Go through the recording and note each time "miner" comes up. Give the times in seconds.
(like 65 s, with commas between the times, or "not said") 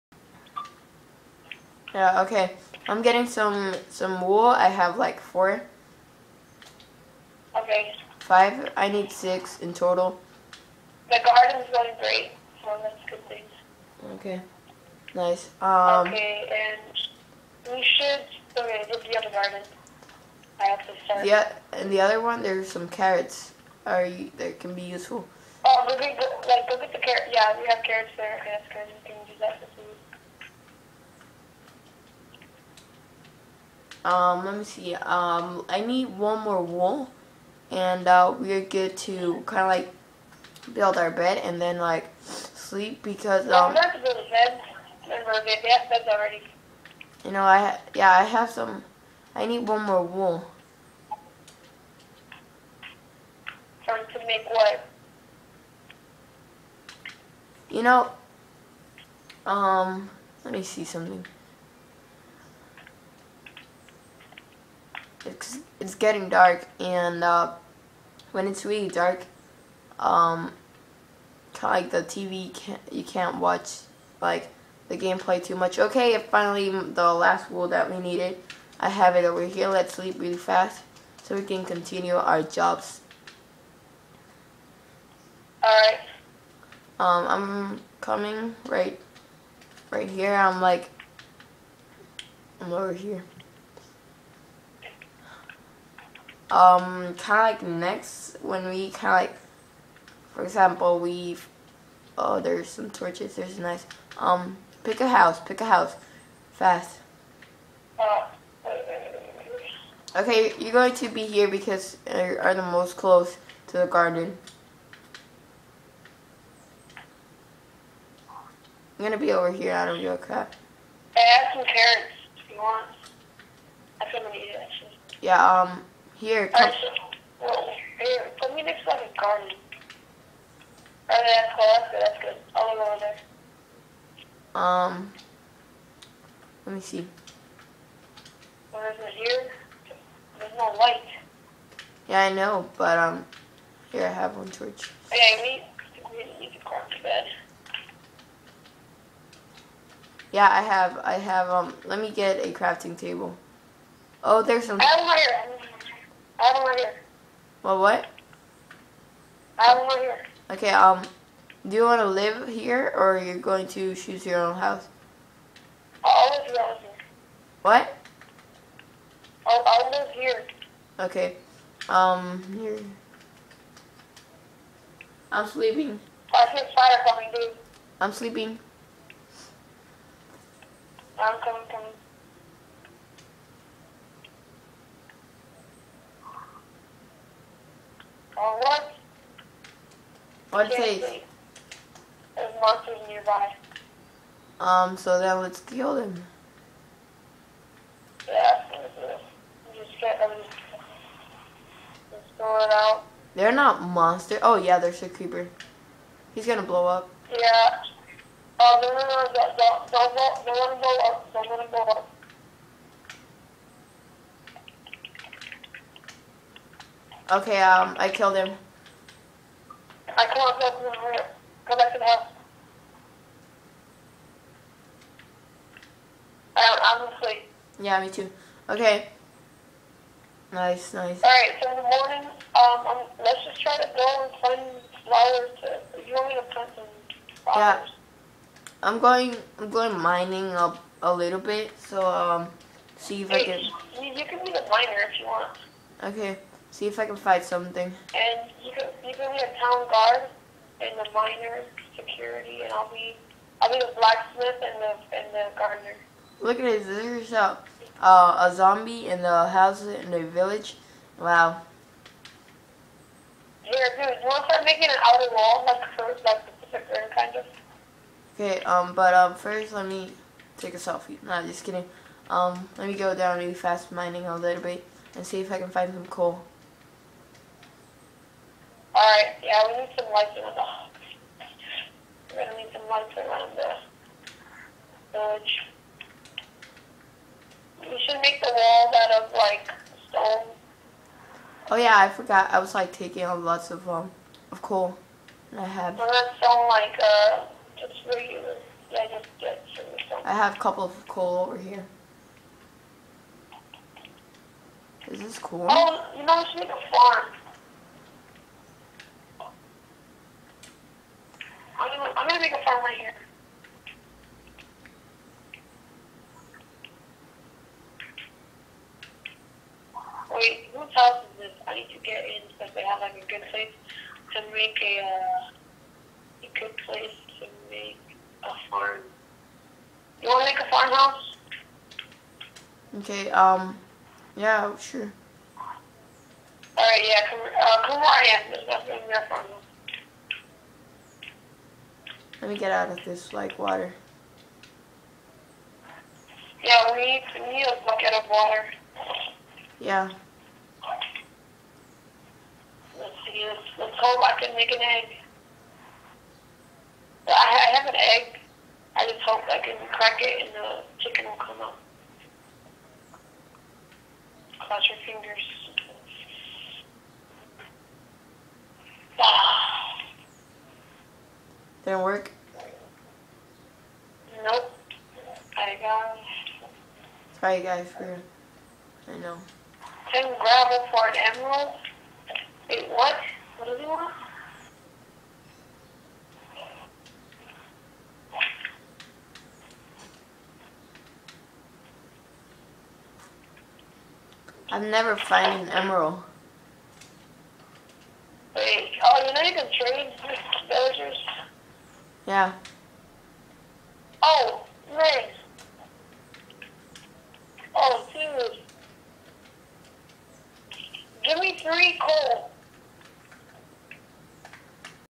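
244 s, 251 s.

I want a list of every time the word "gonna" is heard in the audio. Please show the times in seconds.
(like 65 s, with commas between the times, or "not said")
119 s, 206 s, 282 s, 312 s.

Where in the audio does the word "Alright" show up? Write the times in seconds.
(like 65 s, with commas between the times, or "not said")
85 s, 231 s, 336 s.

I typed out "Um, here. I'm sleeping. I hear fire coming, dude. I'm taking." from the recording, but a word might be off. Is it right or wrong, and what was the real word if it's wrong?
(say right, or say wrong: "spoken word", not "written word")
wrong: "sleeping", not "taking".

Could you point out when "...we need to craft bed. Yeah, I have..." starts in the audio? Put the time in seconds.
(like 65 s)
146 s.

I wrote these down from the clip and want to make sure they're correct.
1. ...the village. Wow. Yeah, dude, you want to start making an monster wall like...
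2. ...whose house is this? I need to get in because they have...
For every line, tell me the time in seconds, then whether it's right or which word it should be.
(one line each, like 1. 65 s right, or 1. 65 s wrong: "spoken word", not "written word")
1. 260 s wrong: "outer", not "monster"
2. 320 s right.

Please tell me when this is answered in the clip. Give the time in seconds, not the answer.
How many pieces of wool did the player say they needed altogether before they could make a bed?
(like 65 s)
9 s.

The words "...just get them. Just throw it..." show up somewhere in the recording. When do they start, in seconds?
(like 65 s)
199 s.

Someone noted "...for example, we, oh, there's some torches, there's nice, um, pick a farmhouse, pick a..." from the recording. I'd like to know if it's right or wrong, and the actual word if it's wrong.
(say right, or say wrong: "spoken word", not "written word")
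wrong: "house", not "farmhouse".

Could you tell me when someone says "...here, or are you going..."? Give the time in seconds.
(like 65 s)
162 s.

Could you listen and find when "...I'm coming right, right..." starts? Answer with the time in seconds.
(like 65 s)
87 s.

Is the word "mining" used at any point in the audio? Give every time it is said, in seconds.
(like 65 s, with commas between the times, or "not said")
239 s, 273 s.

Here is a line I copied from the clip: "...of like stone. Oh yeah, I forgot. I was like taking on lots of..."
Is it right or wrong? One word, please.
right.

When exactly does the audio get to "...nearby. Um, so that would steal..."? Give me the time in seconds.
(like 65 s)
193 s.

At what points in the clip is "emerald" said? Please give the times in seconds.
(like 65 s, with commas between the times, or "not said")
381 s, 395 s.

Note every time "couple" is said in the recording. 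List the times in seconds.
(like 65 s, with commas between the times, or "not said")
300 s.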